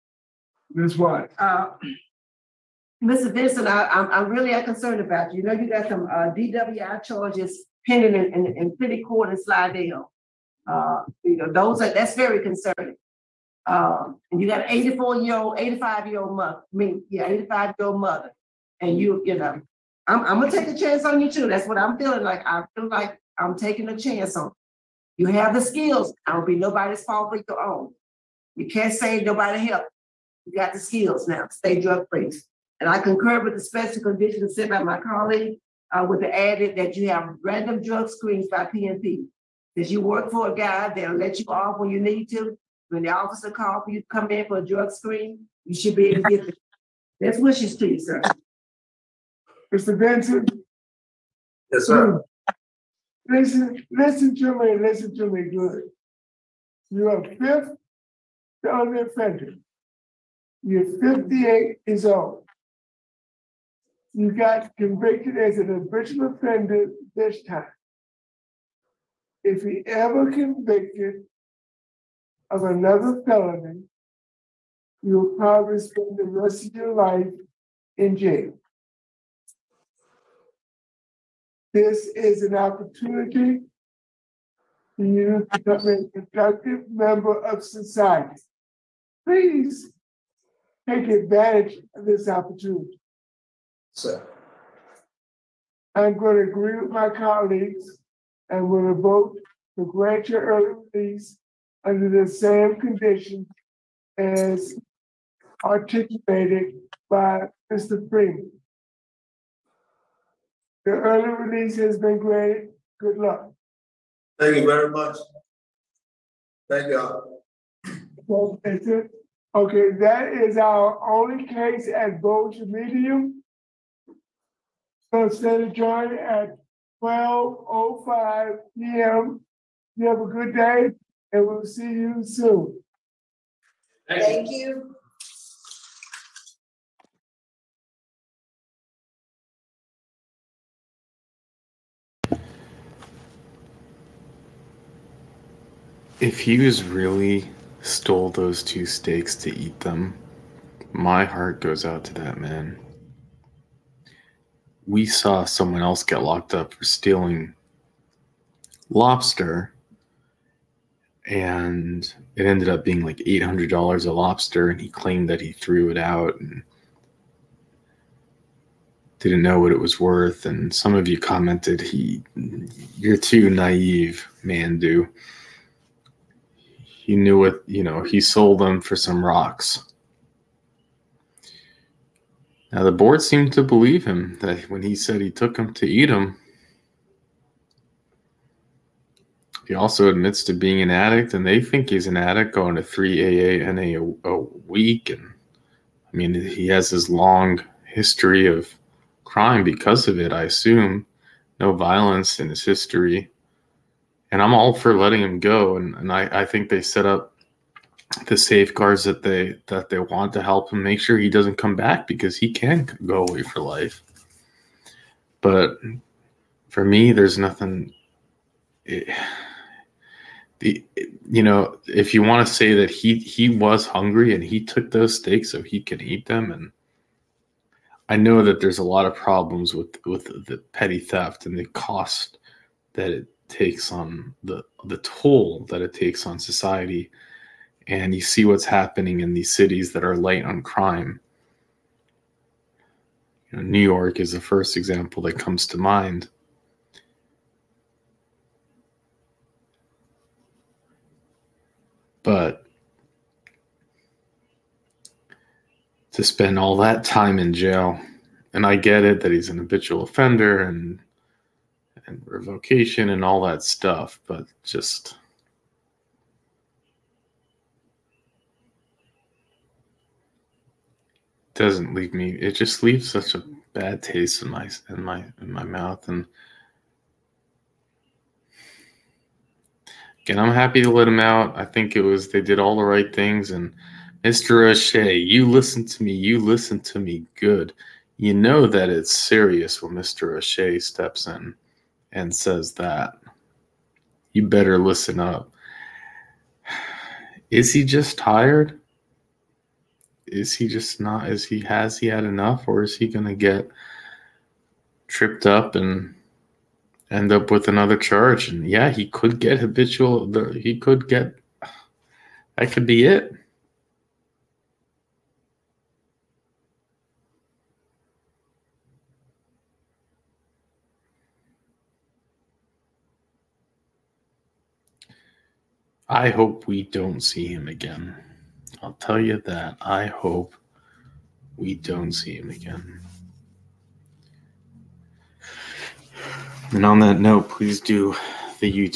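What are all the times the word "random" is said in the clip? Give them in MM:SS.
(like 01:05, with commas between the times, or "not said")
00:37.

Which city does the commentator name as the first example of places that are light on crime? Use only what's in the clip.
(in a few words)
New York.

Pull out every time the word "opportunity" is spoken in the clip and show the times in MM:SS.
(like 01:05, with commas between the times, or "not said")
01:22, 01:32.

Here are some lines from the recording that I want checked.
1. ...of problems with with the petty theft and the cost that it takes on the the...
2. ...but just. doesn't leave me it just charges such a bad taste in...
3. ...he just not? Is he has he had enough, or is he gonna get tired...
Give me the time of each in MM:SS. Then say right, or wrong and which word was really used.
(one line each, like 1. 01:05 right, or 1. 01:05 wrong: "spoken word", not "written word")
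1. 03:49 right
2. 04:24 wrong: "leaves", not "charges"
3. 05:00 wrong: "tripped", not "tired".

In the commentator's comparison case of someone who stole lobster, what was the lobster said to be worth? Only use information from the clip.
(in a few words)
$800.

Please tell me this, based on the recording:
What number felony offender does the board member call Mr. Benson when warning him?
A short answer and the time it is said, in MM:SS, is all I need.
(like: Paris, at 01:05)
Fifth, at 00:57.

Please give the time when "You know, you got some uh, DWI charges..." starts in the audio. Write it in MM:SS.
00:05.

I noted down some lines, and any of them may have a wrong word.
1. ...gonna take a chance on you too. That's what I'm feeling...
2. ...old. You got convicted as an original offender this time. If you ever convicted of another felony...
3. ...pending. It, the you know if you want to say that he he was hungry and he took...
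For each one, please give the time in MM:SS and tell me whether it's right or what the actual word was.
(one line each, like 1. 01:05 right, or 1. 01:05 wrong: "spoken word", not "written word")
1. 00:20 right
2. 01:02 right
3. 03:37 wrong: "nothing", not "pending".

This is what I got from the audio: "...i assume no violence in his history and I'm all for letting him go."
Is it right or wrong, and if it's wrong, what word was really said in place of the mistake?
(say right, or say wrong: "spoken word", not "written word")
right.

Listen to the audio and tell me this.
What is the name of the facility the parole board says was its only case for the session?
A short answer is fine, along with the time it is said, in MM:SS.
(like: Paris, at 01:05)
Bossier Medium, at 02:02.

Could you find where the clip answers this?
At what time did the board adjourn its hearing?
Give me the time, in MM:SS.
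02:07.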